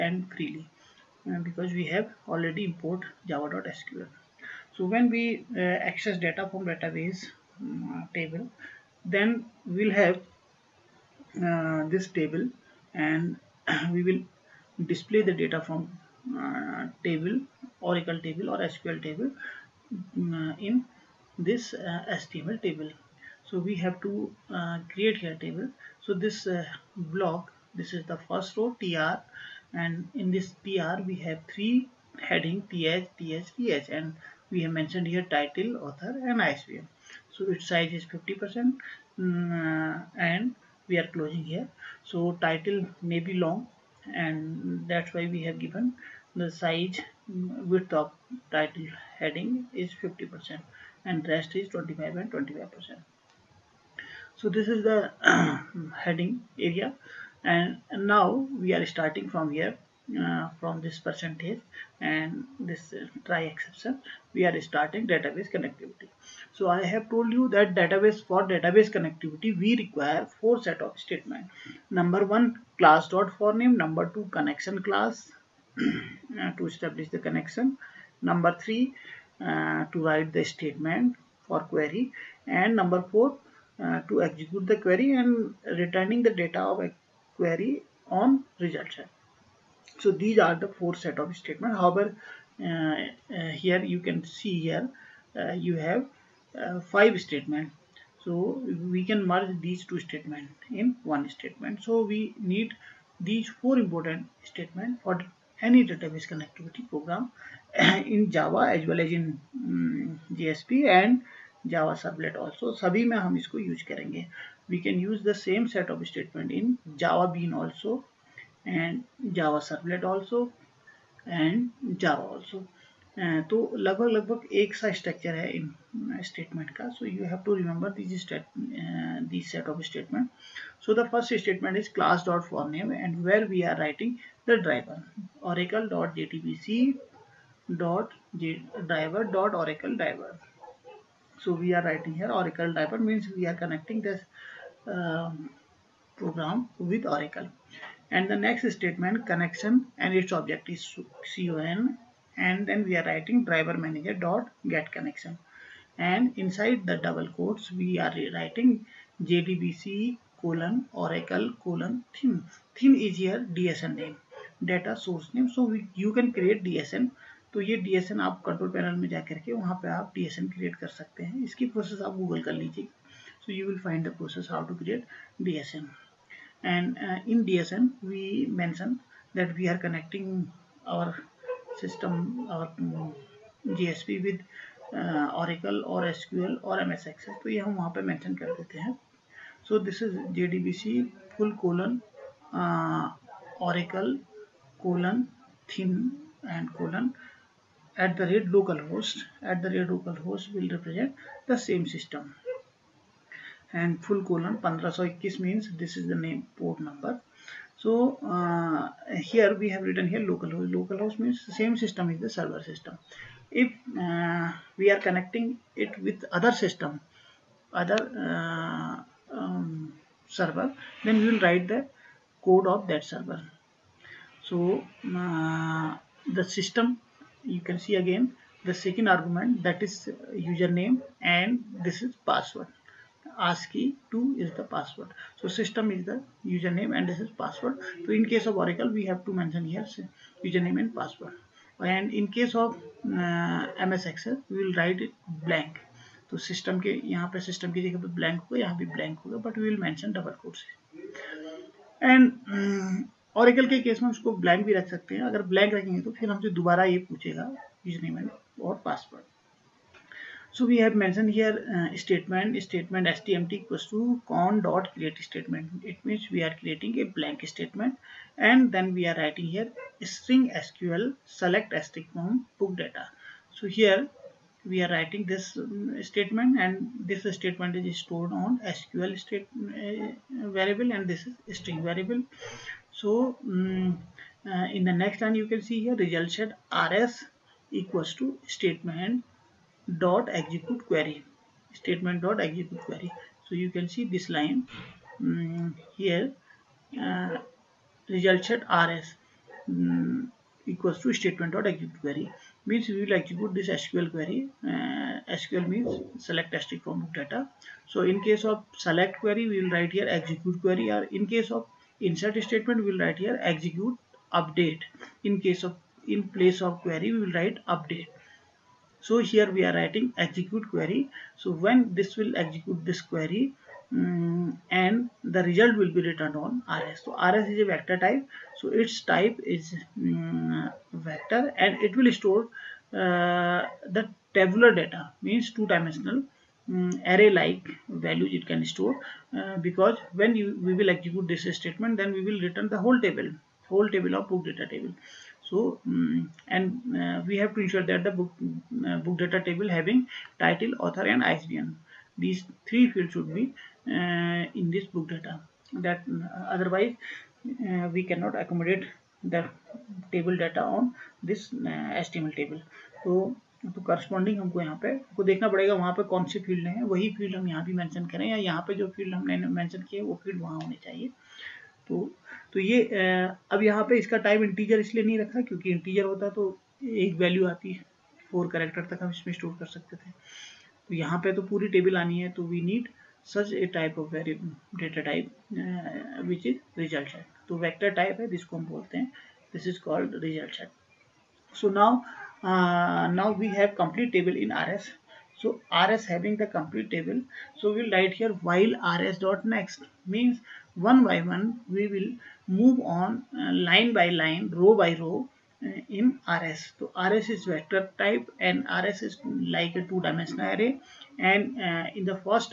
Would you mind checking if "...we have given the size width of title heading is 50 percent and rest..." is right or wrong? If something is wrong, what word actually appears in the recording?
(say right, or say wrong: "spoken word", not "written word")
right.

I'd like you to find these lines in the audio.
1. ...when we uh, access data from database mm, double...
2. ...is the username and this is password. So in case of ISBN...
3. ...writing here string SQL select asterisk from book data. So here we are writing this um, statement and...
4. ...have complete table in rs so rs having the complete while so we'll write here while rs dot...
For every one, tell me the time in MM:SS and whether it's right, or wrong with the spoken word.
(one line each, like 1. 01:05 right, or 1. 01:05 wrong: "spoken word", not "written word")
1. 00:04 wrong: "table", not "double"
2. 03:55 wrong: "Oracle", not "ISBN"
3. 04:29 right
4. 06:33 wrong: "table", not "while".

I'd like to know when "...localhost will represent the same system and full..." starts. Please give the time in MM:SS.
03:19.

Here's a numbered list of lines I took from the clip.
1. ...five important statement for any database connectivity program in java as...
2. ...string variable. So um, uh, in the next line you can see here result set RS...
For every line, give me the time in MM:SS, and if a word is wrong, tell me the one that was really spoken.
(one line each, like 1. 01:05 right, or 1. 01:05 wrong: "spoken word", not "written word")
1. 01:43 wrong: "four", not "five"
2. 04:41 right.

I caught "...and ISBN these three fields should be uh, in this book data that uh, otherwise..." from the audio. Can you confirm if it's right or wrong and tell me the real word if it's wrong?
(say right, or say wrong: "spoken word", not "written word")
right.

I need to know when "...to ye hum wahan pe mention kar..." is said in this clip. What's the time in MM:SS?
03:07.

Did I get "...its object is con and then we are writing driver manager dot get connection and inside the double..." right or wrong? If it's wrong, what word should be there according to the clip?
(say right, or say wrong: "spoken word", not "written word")
right.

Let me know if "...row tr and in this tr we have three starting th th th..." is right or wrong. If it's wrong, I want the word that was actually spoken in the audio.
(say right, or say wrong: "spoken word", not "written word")
wrong: "heading", not "starting".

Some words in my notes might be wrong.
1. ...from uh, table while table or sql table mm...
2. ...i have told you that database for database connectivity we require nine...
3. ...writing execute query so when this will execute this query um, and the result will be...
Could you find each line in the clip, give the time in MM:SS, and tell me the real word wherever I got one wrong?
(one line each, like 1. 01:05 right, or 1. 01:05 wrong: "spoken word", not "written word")
1. 00:15 wrong: "oracle", not "while"
2. 01:06 wrong: "four", not "nine"
3. 05:19 right.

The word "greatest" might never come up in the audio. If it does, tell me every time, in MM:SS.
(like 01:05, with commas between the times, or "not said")
not said.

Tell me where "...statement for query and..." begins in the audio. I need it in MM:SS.
01:20.